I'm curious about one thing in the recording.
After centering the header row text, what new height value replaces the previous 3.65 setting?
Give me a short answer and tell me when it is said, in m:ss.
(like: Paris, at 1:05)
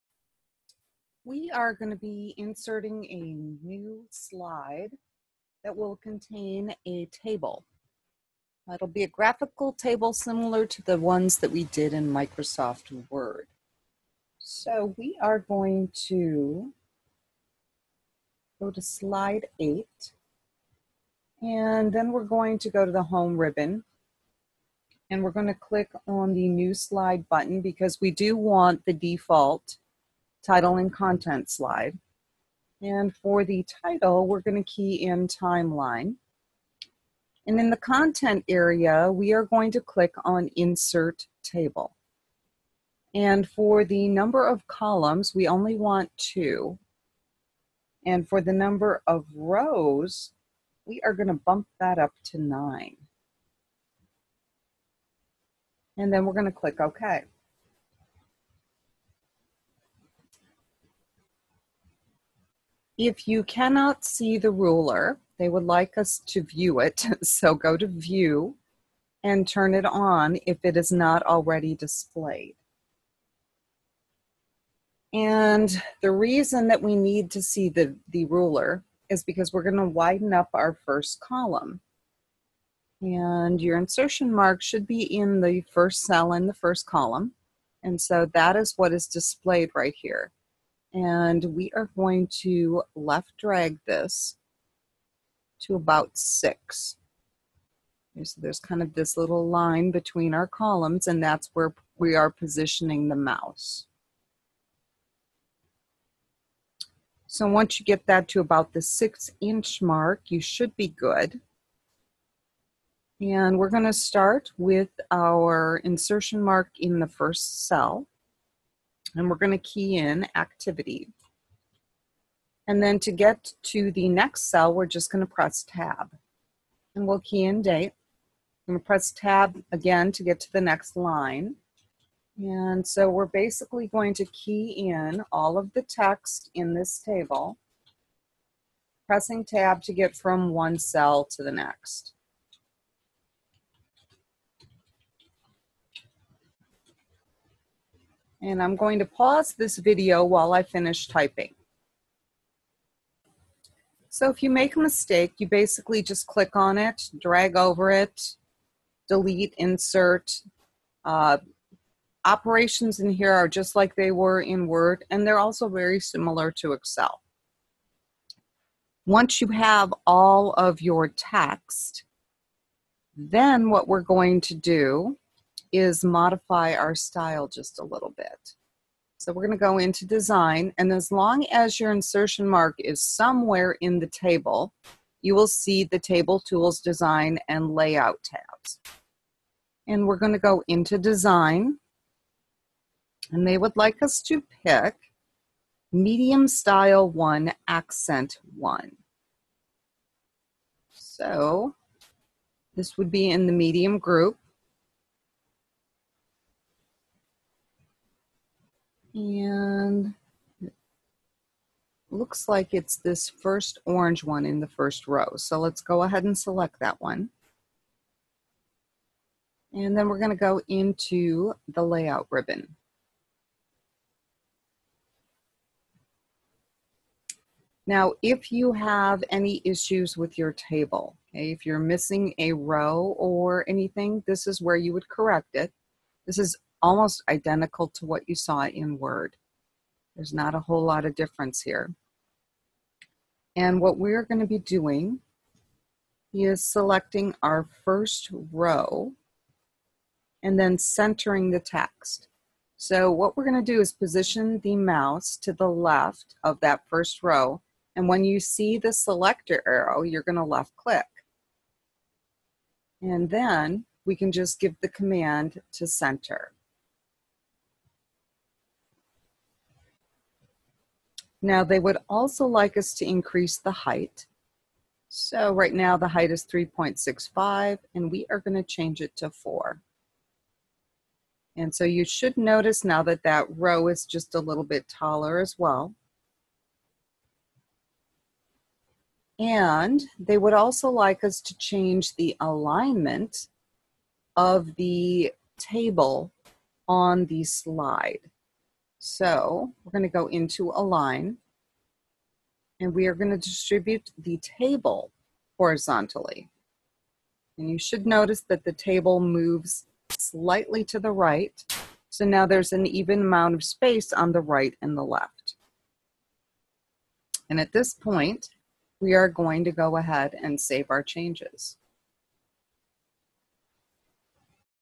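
4, at 4:39.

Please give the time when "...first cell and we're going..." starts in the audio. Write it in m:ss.
1:57.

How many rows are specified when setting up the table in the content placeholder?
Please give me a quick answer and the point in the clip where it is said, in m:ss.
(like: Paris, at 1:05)
9, at 0:52.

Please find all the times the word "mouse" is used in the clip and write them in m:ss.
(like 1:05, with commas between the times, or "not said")
1:43, 4:14.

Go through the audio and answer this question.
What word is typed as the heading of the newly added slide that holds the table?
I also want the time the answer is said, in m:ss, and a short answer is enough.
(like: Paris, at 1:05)
Timeline, at 0:35.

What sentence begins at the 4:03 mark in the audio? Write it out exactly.
And what we're going to be doing is selecting our first row and then centering the text.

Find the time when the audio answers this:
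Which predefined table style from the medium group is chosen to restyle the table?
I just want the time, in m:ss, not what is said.
3:15.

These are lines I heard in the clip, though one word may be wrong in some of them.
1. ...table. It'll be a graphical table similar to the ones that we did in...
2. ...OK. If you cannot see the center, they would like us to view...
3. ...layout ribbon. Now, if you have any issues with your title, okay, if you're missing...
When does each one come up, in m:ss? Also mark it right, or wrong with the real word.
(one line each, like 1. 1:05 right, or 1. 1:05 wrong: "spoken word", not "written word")
1. 0:07 right
2. 0:56 wrong: "ruler", not "center"
3. 3:41 wrong: "table", not "title".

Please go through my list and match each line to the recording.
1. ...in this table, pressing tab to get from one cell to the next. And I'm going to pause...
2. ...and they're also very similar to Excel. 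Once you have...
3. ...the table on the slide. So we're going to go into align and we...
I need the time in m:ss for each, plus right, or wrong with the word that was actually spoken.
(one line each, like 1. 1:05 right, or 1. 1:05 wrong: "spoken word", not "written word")
1. 2:16 right
2. 2:45 right
3. 4:54 right.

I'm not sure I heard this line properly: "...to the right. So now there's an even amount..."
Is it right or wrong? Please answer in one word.
right.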